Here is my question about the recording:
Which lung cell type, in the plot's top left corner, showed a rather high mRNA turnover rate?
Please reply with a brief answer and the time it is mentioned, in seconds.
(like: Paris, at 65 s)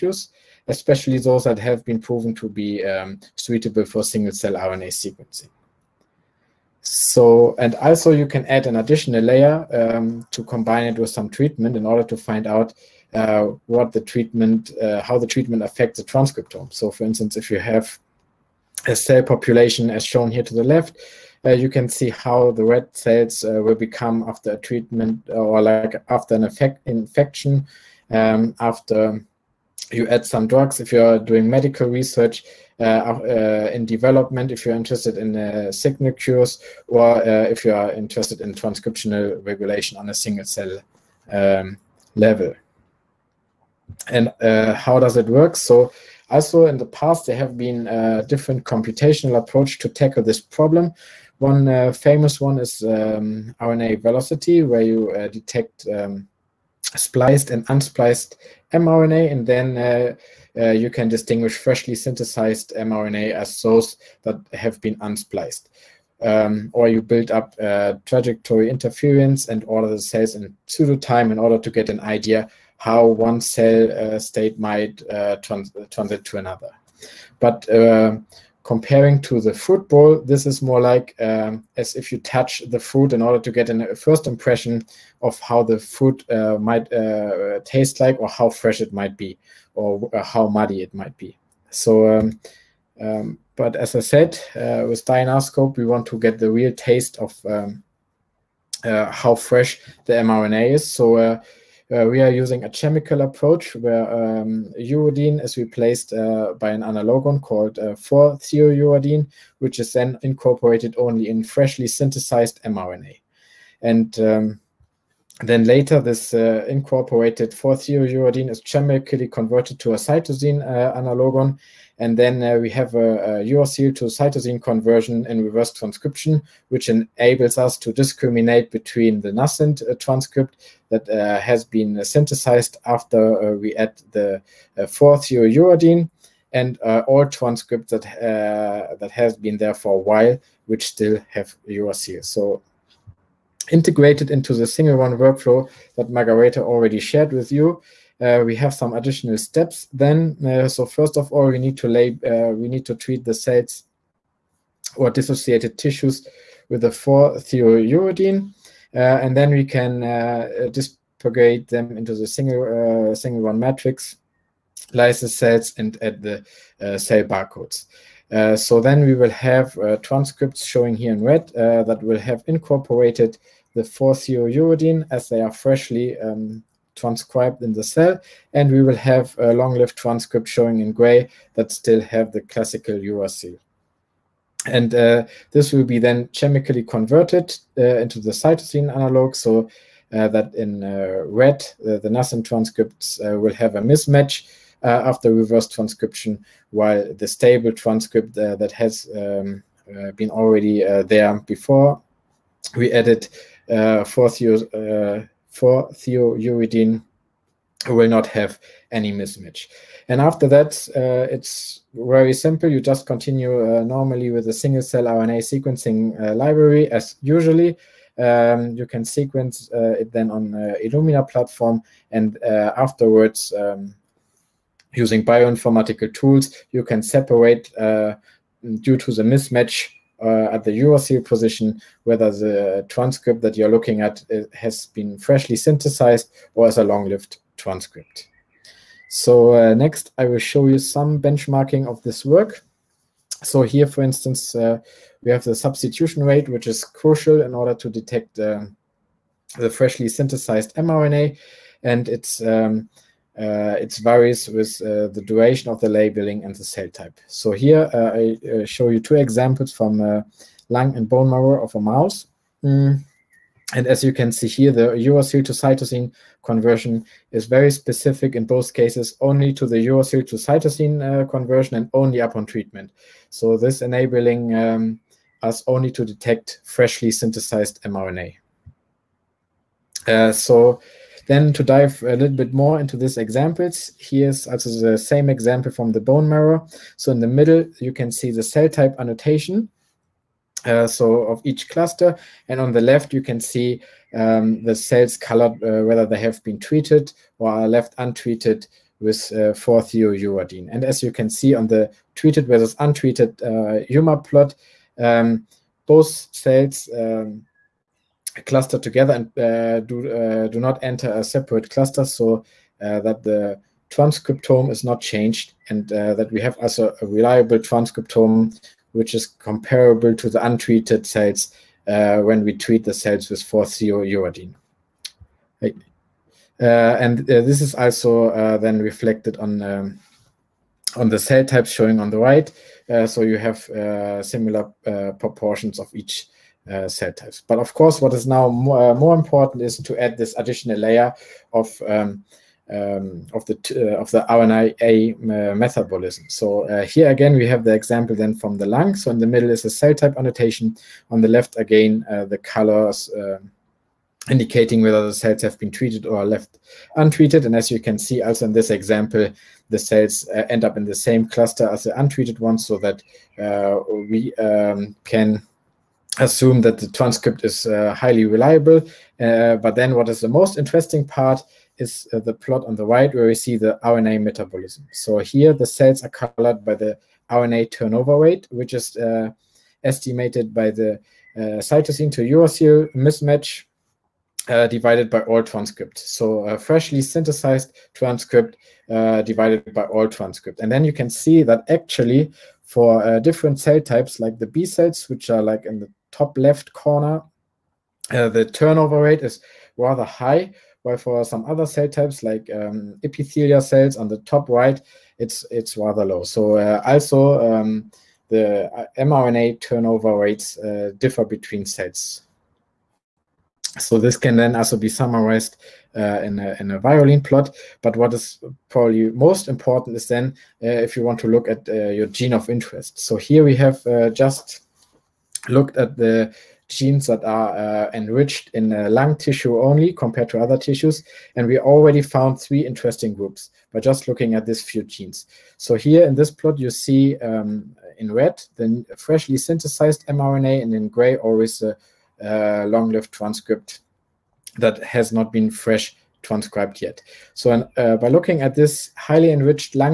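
B cells, at 394 s.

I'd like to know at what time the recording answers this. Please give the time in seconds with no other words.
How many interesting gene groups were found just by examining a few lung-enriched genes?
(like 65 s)
432 s.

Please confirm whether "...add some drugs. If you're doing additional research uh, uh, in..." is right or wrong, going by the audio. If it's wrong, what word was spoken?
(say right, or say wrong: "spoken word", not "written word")
wrong: "medical", not "additional".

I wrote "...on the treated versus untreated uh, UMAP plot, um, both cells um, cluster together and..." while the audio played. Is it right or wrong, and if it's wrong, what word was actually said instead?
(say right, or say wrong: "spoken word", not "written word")
right.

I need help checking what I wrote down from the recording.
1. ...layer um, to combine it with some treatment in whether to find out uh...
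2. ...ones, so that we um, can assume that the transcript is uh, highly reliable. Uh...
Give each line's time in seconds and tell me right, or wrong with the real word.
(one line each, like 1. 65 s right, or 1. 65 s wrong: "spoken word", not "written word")
1. 9 s wrong: "order", not "whether"
2. 362 s right.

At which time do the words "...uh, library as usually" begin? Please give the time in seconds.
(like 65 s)
216 s.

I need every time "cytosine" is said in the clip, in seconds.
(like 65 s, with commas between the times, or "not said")
119 s, 124 s, 188 s, 265 s, 270 s, 381 s.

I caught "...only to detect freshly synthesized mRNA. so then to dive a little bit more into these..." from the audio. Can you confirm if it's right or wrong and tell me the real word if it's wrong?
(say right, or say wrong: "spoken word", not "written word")
right.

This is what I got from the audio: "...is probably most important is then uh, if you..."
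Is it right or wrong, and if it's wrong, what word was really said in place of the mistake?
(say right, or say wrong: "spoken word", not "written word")
right.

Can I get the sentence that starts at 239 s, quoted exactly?
So uh, next, I will show you some benchmarking of this work.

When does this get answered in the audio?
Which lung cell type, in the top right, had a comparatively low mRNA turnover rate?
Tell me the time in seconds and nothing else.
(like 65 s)
403 s.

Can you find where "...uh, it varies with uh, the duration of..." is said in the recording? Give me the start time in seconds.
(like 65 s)
253 s.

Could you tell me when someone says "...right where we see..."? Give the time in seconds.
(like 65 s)
372 s.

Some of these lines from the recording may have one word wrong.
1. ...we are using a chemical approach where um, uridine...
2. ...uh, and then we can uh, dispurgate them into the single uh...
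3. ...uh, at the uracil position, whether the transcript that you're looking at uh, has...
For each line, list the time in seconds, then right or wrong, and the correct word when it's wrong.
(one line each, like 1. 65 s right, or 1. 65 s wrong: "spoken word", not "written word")
1. 102 s right
2. 158 s right
3. 230 s right.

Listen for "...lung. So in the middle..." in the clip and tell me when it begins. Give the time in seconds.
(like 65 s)
348 s.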